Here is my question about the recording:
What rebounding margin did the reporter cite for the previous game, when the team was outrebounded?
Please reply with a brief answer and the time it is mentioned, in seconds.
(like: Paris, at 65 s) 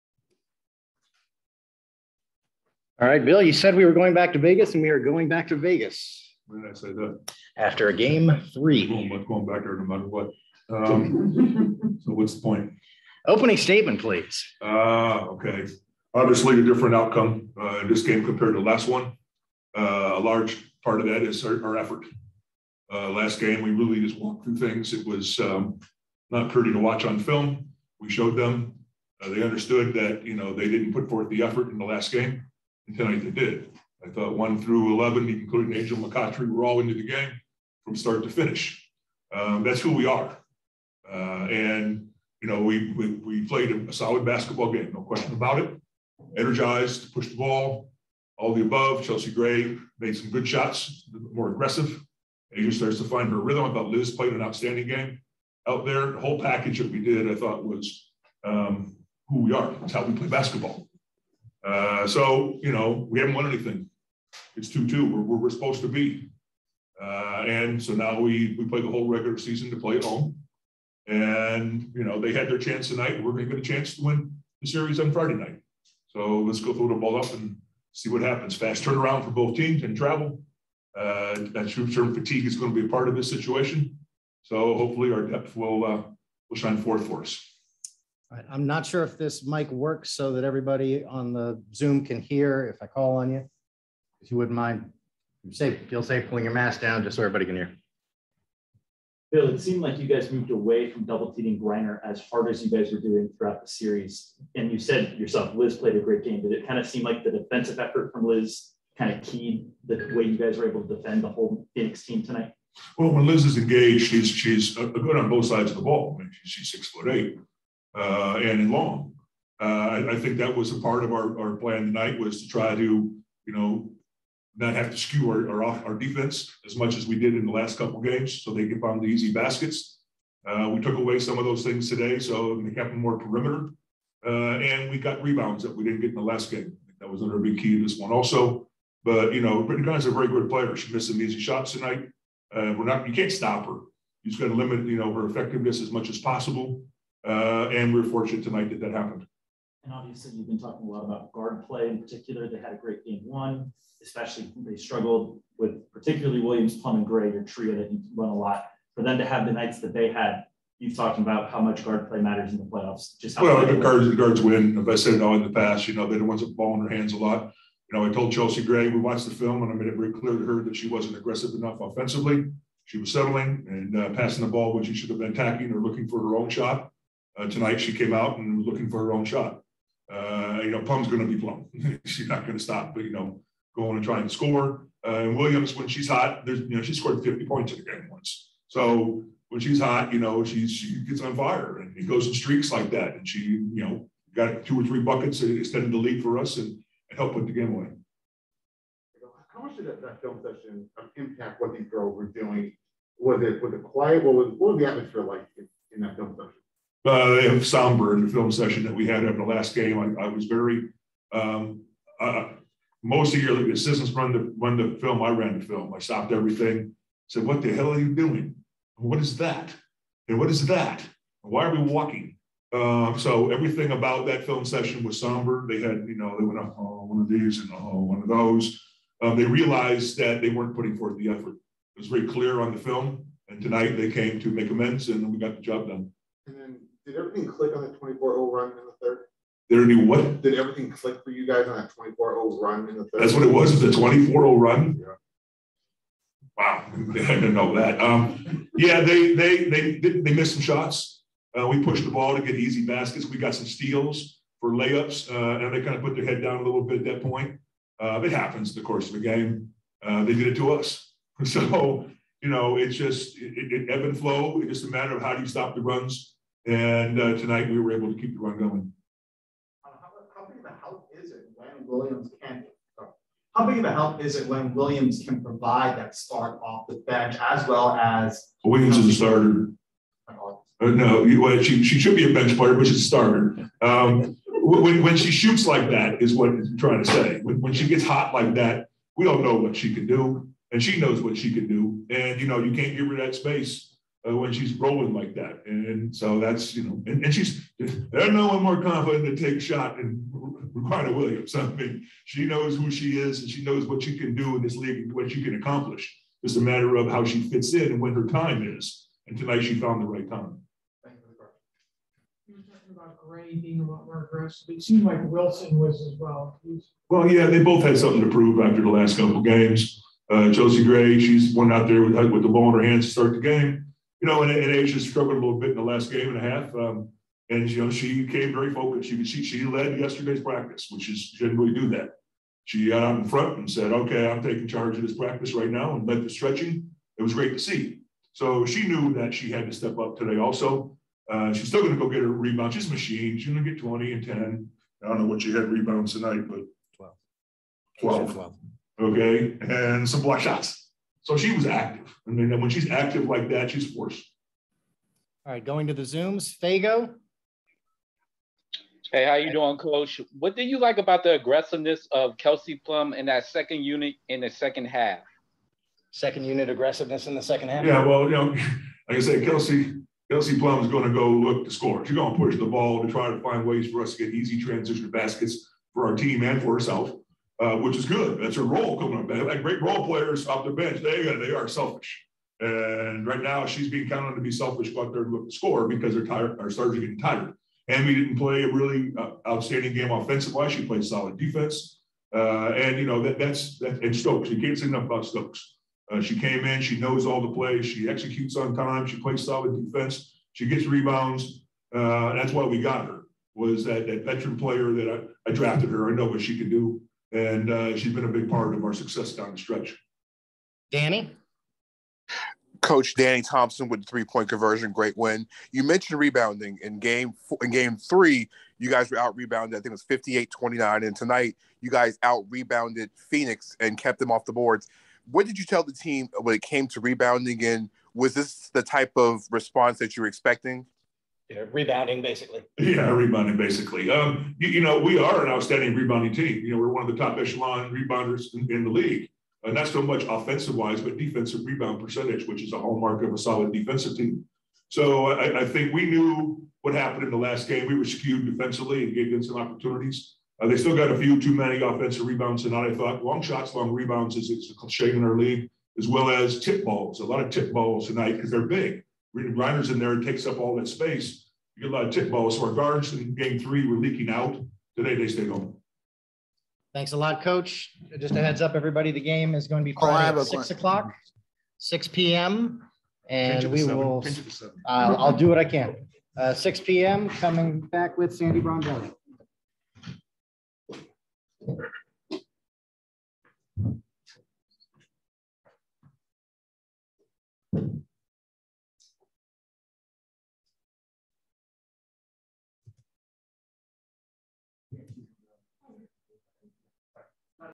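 58-29, at 420 s.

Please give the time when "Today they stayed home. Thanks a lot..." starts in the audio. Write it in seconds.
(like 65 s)
464 s.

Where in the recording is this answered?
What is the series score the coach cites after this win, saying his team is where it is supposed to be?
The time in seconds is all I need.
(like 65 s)
64 s.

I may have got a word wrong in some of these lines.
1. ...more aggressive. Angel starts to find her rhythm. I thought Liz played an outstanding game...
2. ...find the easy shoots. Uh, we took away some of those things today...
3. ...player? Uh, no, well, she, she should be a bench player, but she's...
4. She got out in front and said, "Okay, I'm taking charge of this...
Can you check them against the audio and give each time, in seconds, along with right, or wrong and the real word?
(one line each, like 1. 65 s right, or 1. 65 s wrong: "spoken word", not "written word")
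1. 51 s right
2. 128 s wrong: "baskets", not "shoots"
3. 279 s wrong: "starter", not "player"
4. 332 s right.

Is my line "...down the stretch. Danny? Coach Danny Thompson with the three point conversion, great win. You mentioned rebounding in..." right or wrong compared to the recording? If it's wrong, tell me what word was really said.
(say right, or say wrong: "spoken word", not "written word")
right.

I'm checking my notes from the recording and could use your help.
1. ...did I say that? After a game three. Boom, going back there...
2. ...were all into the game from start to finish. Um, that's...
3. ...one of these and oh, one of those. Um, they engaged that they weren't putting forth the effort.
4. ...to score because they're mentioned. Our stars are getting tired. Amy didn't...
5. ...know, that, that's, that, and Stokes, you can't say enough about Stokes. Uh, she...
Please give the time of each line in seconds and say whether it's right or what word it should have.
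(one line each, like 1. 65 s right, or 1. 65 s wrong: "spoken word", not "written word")
1. 6 s right
2. 36 s right
3. 227 s wrong: "realized", not "engaged"
4. 385 s wrong: "tired", not "mentioned"
5. 393 s right.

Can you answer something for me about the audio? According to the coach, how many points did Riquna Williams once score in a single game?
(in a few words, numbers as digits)
50.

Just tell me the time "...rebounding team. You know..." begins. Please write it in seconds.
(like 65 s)
435 s.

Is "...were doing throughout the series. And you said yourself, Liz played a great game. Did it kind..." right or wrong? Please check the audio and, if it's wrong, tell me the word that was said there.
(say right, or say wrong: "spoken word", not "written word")
right.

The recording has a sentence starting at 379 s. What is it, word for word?
They have great role players off the bench.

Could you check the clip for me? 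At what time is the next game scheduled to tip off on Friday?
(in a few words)
6 p.m.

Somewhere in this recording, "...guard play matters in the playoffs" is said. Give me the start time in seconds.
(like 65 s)
161 s.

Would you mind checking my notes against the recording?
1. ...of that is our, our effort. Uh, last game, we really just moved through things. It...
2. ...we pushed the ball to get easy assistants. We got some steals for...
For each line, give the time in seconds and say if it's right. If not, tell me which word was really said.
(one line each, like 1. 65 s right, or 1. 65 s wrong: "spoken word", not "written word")
1. 21 s wrong: "walked", not "moved"
2. 251 s wrong: "baskets", not "assistants".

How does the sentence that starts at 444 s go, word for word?
So uh, I, I think we knew what happened in the last game.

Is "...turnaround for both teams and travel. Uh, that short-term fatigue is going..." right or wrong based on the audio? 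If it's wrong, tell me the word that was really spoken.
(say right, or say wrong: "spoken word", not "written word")
right.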